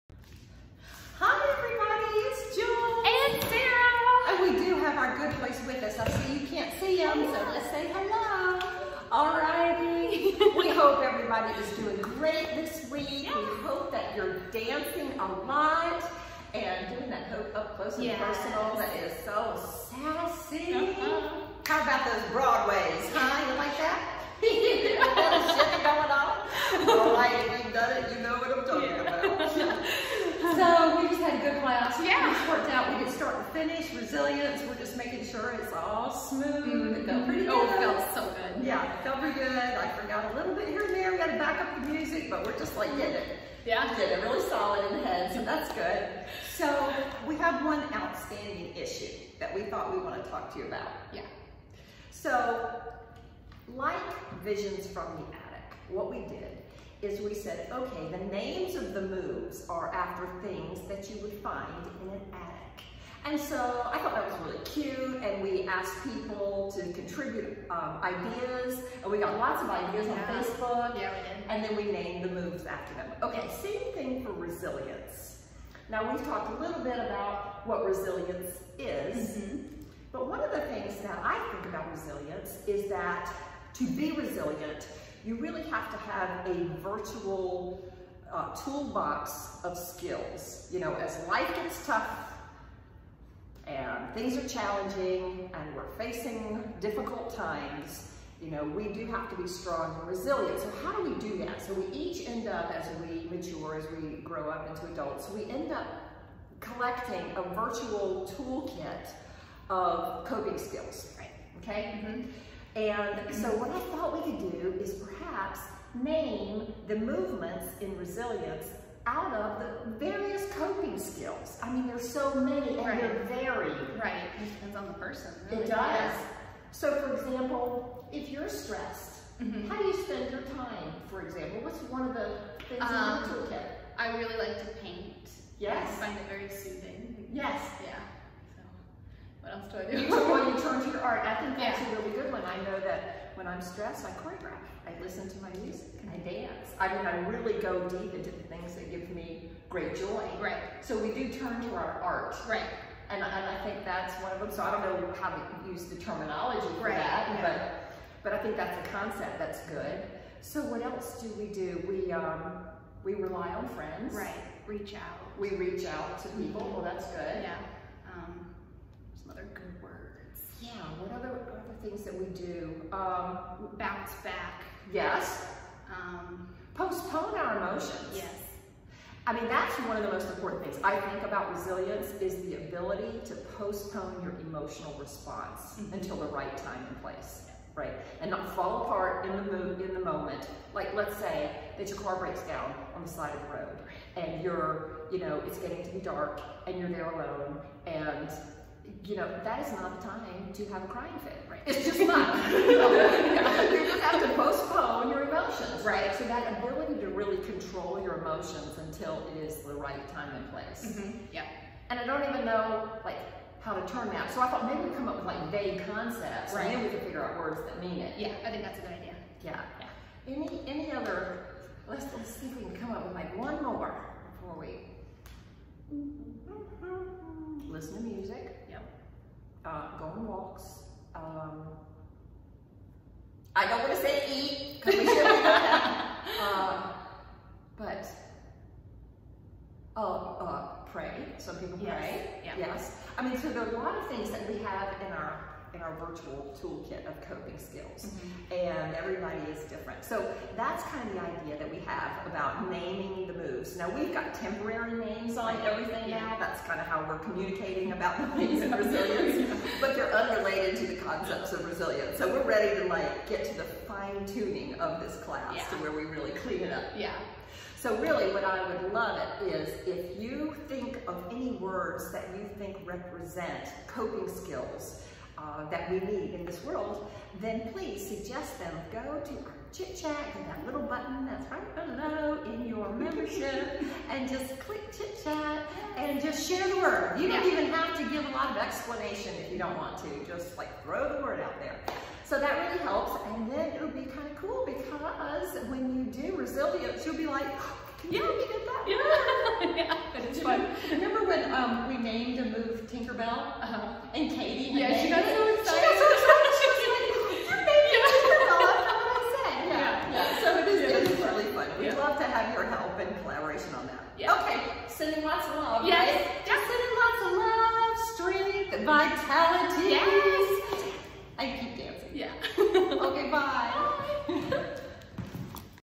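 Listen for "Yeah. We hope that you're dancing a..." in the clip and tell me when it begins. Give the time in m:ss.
0:13.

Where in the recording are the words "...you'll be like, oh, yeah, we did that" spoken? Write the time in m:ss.
4:57.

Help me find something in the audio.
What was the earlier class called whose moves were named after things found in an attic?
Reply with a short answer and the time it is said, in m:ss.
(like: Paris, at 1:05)
Visions from the Attic, at 0:54.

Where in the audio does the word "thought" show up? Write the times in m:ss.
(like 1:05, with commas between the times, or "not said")
0:49, 1:03, 1:53, 3:34.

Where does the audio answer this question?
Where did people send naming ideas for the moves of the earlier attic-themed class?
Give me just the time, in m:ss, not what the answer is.
1:10.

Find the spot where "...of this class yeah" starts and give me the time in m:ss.
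4:24.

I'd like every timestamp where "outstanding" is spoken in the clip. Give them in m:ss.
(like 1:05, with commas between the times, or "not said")
0:48.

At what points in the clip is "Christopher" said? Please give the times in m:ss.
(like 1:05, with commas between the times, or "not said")
not said.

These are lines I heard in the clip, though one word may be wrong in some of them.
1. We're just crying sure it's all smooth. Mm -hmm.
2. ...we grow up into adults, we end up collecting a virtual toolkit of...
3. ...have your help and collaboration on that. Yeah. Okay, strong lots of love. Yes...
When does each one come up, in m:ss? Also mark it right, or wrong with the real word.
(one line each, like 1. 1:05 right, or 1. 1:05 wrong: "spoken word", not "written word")
1. 0:34 wrong: "making", not "crying"
2. 1:44 right
3. 5:12 wrong: "sending", not "strong".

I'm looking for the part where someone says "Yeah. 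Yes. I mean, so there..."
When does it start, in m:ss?
4:02.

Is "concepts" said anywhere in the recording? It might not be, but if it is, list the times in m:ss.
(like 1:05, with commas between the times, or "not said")
2:38, 3:35, 4:21.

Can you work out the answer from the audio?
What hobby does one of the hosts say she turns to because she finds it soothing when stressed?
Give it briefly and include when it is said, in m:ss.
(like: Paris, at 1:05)
Paint, at 2:14.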